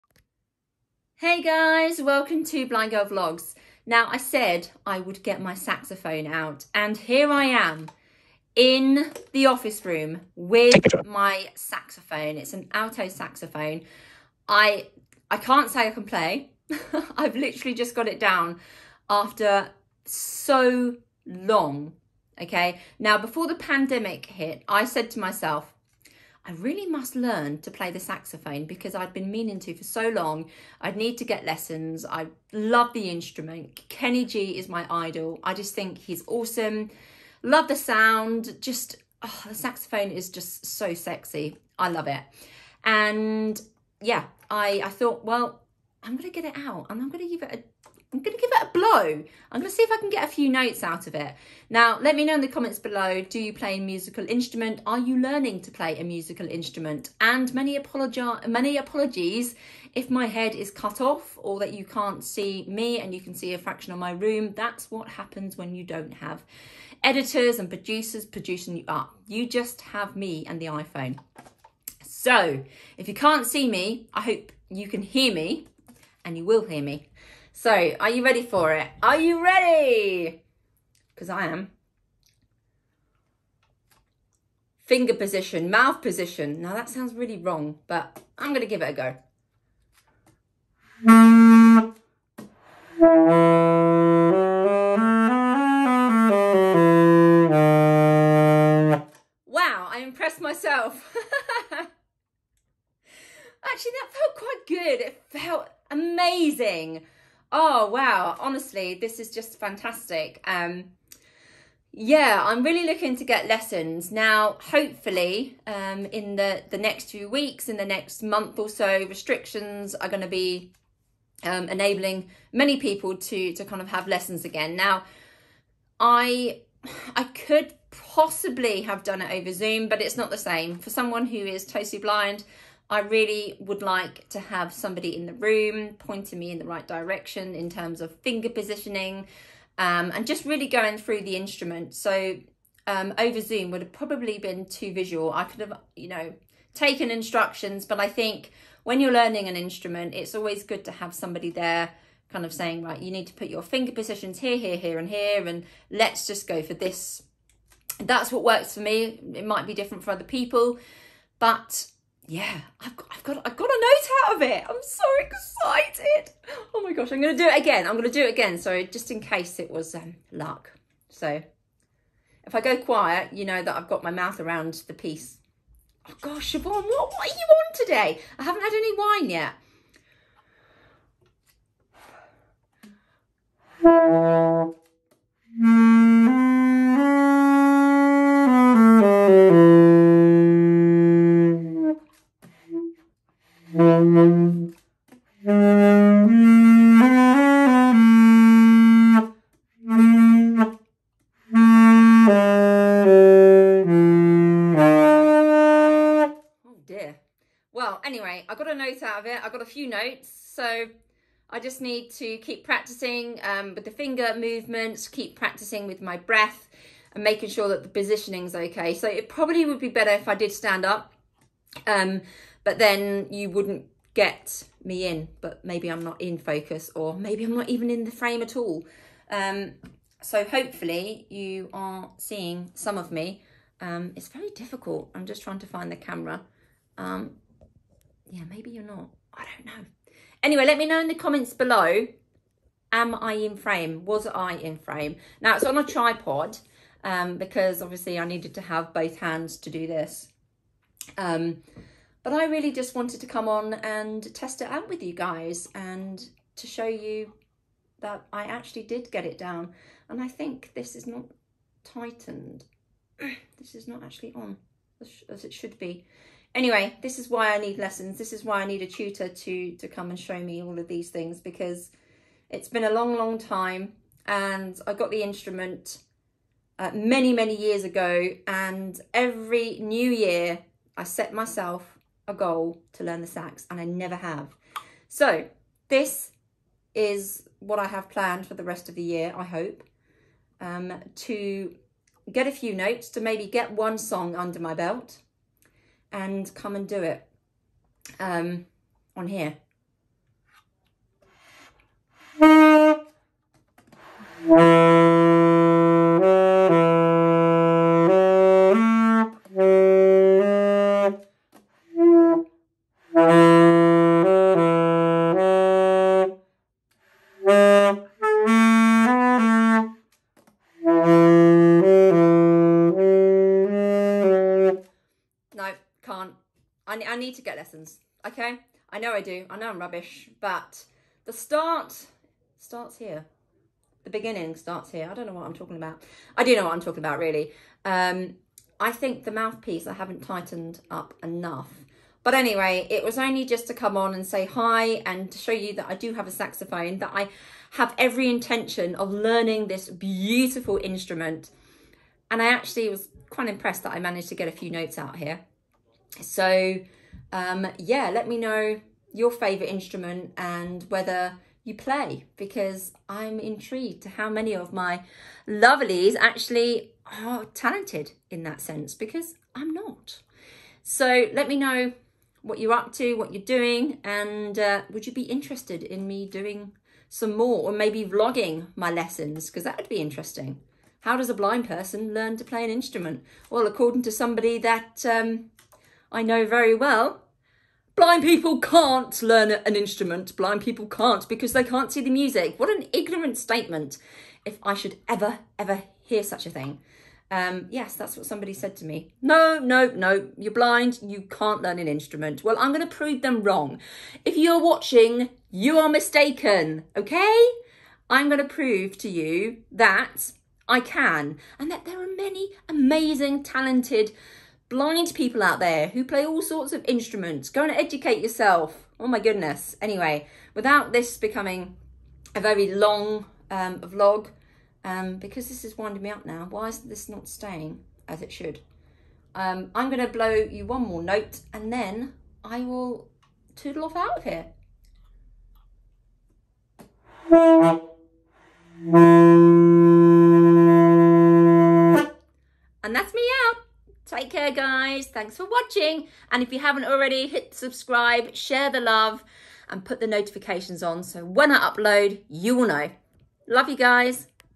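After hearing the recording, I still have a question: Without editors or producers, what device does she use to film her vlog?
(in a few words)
iPhone.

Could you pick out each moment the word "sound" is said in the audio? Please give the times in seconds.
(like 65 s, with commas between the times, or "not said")
37 s, 86 s.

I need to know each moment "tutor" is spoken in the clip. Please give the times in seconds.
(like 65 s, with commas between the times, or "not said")
268 s.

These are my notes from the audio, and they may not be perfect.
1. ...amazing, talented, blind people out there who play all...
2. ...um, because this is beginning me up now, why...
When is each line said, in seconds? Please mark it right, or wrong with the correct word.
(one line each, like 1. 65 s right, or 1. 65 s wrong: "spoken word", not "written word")
1. 412 s right
2. 424 s wrong: "winding", not "beginning".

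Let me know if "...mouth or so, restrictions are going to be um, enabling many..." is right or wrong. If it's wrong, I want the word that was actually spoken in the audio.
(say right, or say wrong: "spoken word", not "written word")
wrong: "month", not "mouth".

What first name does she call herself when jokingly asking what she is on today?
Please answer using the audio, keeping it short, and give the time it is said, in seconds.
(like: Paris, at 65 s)
Siobhan, at 176 s.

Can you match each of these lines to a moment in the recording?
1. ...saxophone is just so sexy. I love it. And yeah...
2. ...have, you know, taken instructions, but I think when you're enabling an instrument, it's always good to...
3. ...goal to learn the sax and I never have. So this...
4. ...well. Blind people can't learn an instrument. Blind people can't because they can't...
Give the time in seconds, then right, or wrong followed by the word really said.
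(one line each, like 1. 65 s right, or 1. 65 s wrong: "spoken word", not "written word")
1. 39 s right
2. 145 s wrong: "learning", not "enabling"
3. 282 s right
4. 386 s right.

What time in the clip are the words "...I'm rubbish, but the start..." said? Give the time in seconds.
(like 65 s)
329 s.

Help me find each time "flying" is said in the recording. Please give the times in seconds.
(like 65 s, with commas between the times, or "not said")
not said.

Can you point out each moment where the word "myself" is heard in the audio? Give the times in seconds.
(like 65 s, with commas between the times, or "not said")
25 s, 100 s, 281 s.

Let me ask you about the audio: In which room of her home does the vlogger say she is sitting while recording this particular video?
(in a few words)
office room.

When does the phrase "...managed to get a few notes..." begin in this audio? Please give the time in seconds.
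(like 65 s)
353 s.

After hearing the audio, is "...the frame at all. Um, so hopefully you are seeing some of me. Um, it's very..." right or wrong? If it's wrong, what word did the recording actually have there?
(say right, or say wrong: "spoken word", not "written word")
right.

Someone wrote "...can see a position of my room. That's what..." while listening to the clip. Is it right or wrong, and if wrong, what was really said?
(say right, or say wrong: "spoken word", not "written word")
wrong: "fraction", not "position".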